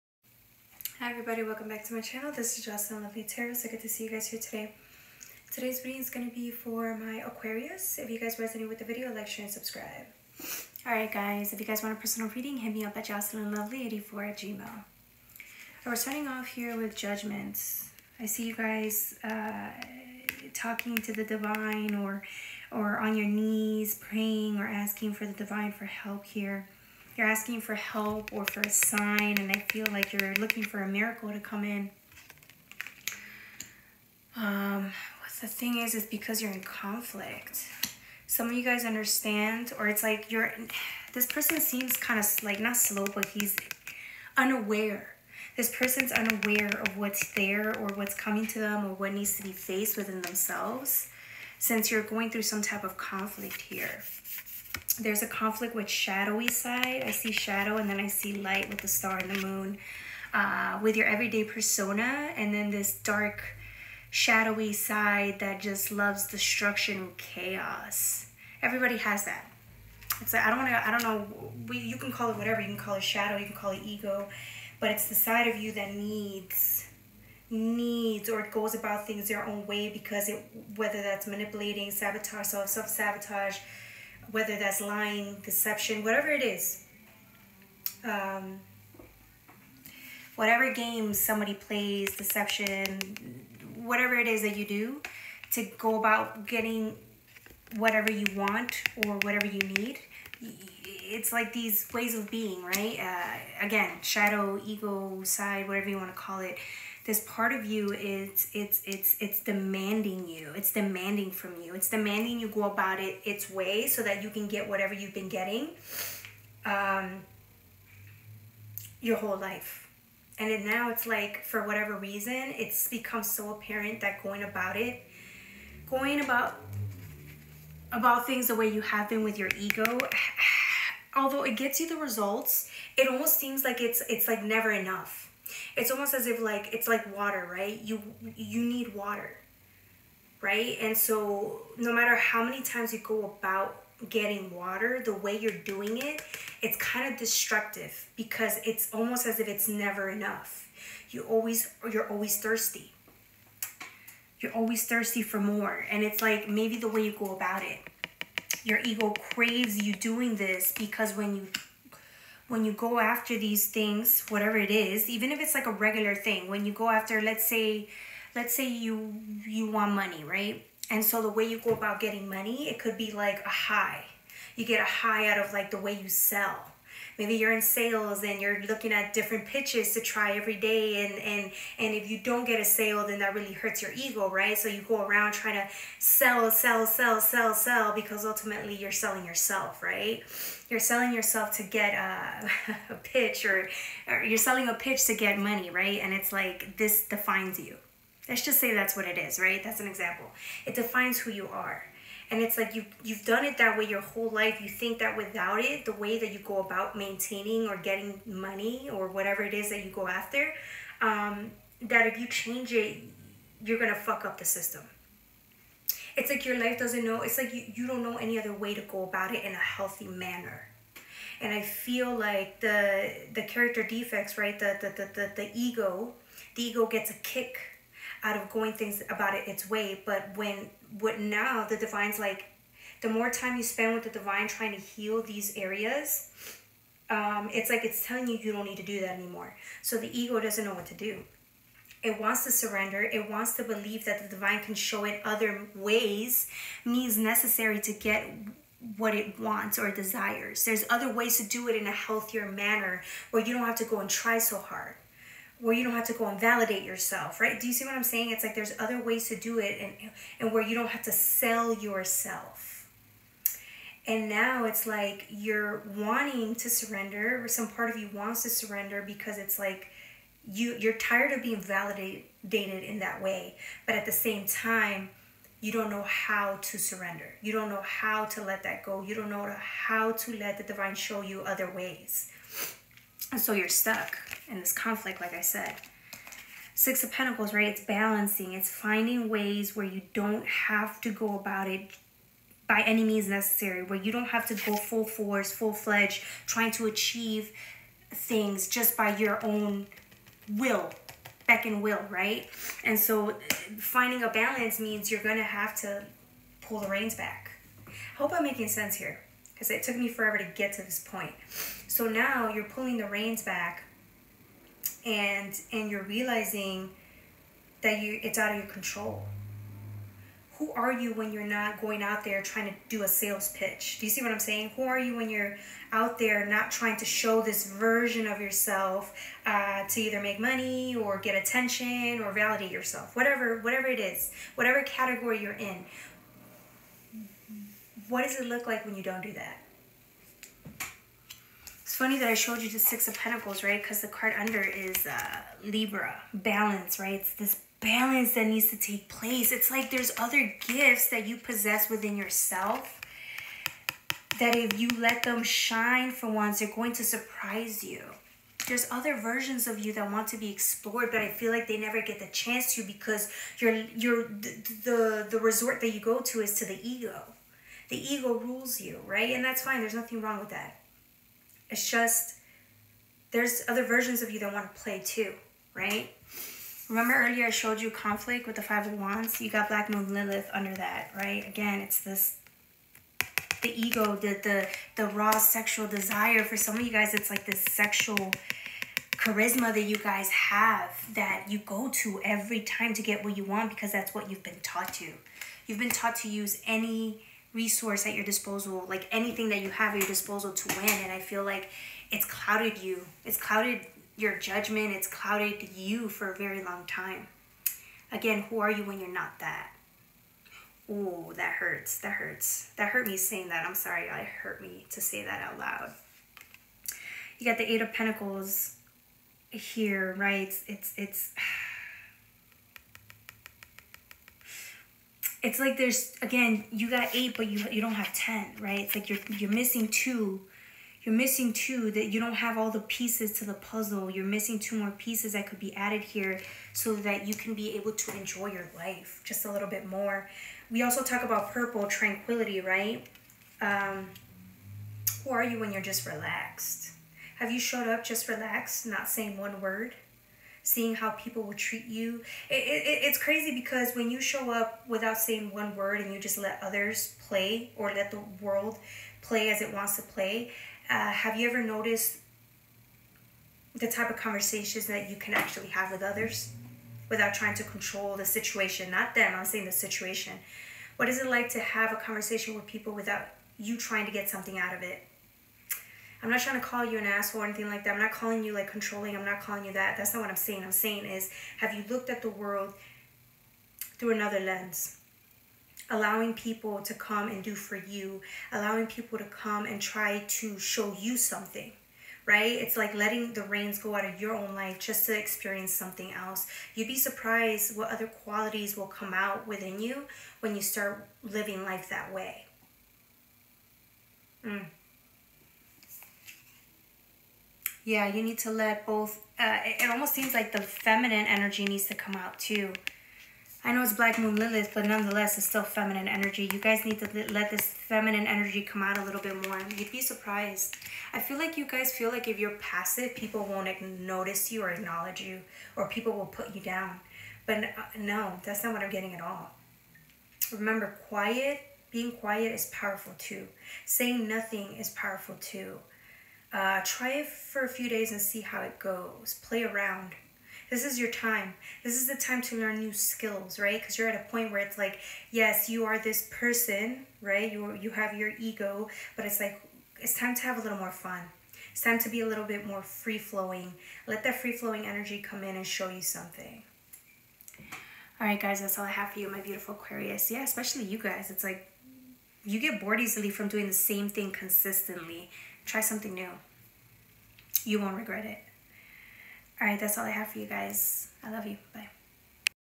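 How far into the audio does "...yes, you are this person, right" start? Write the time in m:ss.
9:05.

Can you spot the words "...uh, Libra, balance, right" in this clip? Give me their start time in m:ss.
5:45.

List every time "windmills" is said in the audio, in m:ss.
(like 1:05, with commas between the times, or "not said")
not said.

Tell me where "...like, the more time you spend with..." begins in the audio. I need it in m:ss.
3:52.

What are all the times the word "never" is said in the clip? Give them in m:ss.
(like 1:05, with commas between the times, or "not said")
2:14, 2:29, 6:01.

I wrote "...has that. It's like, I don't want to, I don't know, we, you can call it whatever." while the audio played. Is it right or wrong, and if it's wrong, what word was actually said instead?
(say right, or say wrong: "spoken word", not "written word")
right.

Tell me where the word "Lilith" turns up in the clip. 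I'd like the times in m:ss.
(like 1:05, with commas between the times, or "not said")
6:20, 8:34.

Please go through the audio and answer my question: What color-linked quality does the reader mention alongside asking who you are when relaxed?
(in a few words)
purple tranquility.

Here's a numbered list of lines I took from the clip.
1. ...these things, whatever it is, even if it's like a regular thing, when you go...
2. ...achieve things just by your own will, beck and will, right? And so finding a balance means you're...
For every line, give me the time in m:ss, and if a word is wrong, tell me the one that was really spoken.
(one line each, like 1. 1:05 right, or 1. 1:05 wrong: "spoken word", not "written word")
1. 2:43 right
2. 4:56 right.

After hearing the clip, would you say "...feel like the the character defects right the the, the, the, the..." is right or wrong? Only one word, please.
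right.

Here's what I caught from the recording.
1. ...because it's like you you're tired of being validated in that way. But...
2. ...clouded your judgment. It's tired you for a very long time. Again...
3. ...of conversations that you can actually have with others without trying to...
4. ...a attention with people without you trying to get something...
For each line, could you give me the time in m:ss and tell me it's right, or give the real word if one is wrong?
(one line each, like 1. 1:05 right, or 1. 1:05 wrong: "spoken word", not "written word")
1. 4:29 right
2. 6:43 wrong: "clouded", not "tired"
3. 7:44 right
4. 7:51 wrong: "conversation", not "attention".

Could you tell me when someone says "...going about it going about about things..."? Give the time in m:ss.
2:04.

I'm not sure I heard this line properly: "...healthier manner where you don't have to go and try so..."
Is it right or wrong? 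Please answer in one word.
right.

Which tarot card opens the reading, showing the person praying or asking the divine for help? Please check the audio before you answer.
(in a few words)
Judgment.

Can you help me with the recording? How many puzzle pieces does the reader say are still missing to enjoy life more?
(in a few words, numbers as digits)
2.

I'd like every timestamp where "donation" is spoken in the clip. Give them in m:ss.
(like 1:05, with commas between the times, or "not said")
not said.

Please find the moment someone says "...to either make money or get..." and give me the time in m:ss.
5:29.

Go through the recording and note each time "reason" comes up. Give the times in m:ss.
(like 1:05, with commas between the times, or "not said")
2:01.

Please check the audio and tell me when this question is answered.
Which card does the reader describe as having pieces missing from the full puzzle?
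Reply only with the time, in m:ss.
6:57.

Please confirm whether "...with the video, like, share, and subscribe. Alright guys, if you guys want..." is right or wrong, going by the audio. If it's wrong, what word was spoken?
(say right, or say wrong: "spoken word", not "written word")
right.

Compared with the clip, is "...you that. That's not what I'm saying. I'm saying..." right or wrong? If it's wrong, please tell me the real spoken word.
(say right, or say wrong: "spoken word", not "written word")
right.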